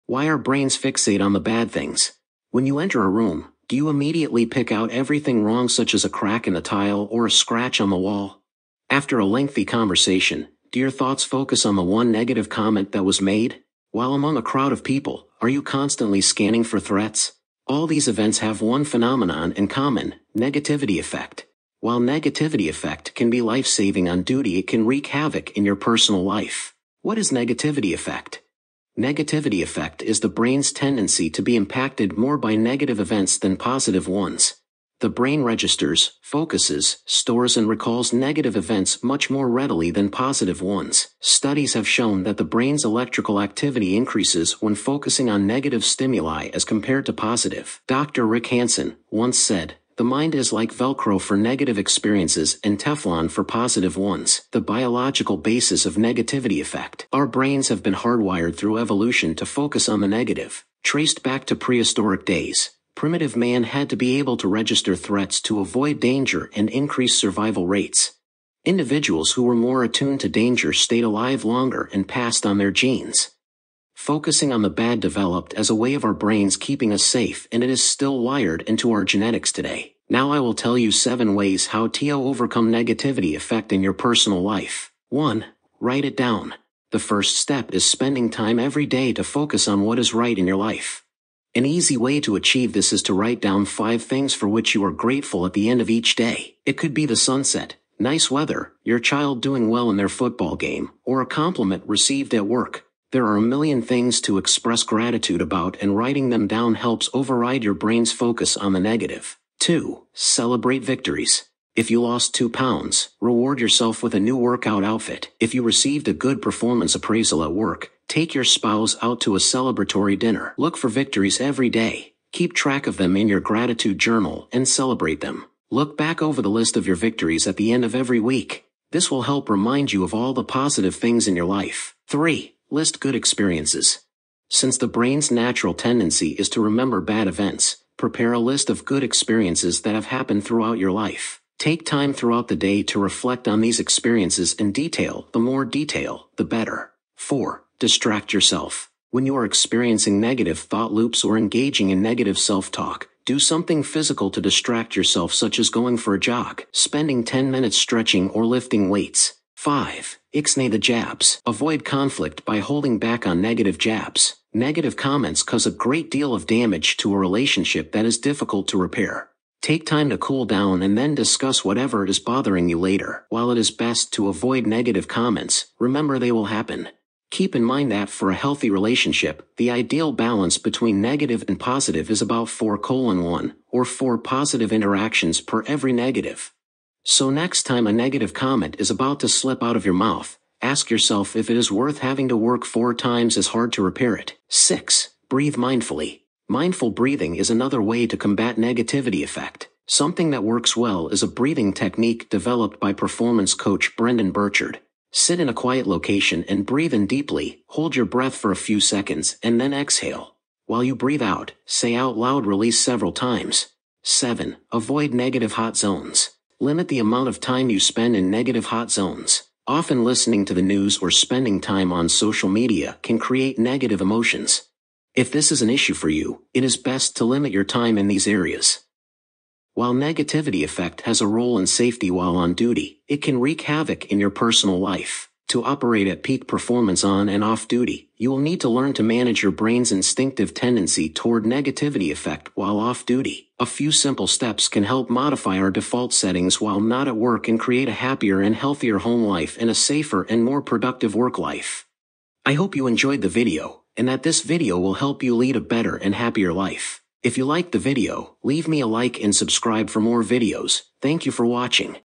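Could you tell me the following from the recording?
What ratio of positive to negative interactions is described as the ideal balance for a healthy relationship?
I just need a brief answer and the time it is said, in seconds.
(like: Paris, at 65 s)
4:1, at 182 s.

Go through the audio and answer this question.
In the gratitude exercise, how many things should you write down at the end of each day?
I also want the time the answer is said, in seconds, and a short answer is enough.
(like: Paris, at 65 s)
5, at 93 s.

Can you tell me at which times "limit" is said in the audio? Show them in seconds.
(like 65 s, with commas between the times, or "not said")
216 s, 227 s.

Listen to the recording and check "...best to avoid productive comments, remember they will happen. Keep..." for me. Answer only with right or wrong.
wrong.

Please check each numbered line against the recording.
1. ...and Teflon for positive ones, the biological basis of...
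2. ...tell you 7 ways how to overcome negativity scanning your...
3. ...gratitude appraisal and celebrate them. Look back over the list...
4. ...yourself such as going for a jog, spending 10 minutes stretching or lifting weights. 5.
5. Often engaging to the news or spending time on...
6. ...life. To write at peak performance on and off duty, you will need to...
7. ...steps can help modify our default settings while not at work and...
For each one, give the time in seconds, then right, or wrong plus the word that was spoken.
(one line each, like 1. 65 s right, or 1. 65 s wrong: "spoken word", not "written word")
1. 52 s right
2. 80 s wrong: "affecting", not "scanning"
3. 123 s wrong: "journal", not "appraisal"
4. 154 s right
5. 219 s wrong: "listening", not "engaging"
6. 234 s wrong: "operate", not "write"
7. 244 s right.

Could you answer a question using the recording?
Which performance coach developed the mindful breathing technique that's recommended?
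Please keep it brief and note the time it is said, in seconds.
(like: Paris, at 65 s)
Brendan Burchard, at 203 s.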